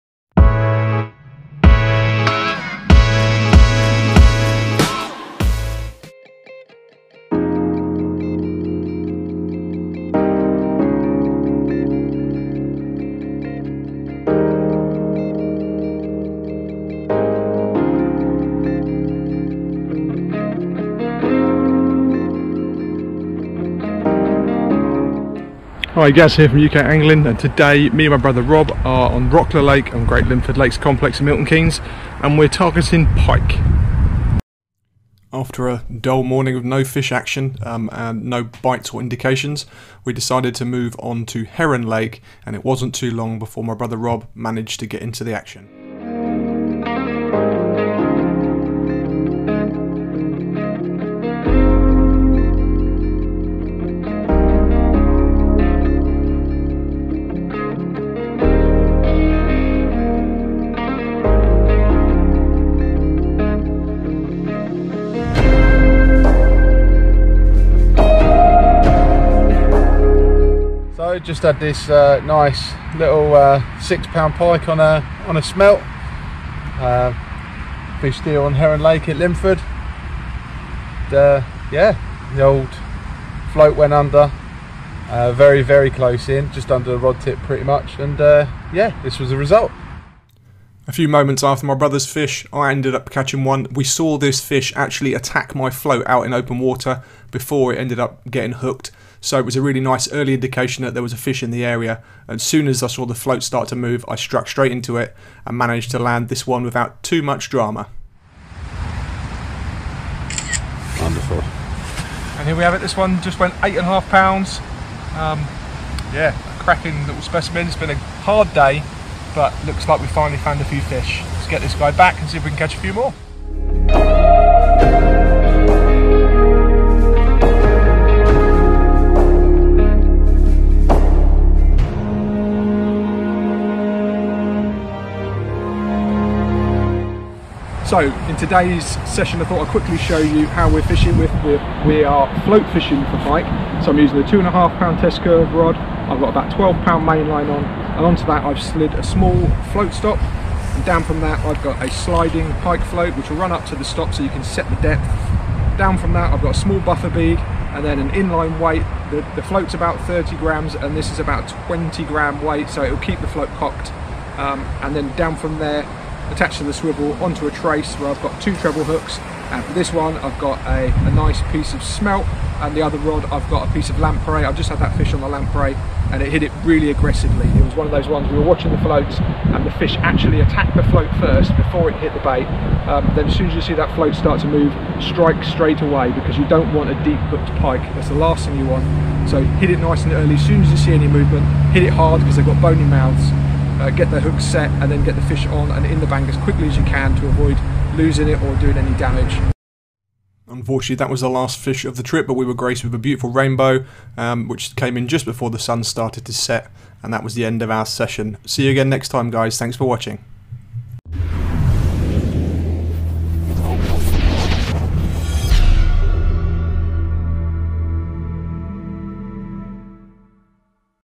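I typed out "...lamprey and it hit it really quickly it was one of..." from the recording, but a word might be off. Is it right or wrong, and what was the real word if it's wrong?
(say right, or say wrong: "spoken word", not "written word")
wrong: "aggressively", not "quickly".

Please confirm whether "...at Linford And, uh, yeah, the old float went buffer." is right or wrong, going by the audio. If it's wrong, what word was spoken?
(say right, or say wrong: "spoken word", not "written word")
wrong: "under", not "buffer".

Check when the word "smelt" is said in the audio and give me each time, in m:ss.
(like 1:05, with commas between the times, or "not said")
1:15, 2:51.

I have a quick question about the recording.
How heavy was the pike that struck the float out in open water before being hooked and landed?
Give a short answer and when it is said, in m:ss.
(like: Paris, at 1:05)
8 and a half pounds, at 1:53.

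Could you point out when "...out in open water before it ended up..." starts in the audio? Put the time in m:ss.
1:36.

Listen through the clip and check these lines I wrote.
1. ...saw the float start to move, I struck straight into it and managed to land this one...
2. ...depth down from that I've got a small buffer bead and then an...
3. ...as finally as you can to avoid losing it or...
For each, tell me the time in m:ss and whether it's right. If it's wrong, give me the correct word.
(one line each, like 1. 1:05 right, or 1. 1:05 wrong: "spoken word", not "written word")
1. 1:42 right
2. 2:34 right
3. 3:16 wrong: "quickly", not "finally".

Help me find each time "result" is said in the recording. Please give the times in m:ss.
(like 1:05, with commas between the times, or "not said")
1:29.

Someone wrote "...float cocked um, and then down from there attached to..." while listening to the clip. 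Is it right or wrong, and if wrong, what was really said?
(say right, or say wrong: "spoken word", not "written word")
right.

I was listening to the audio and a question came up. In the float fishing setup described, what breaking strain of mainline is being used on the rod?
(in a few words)
12 pound.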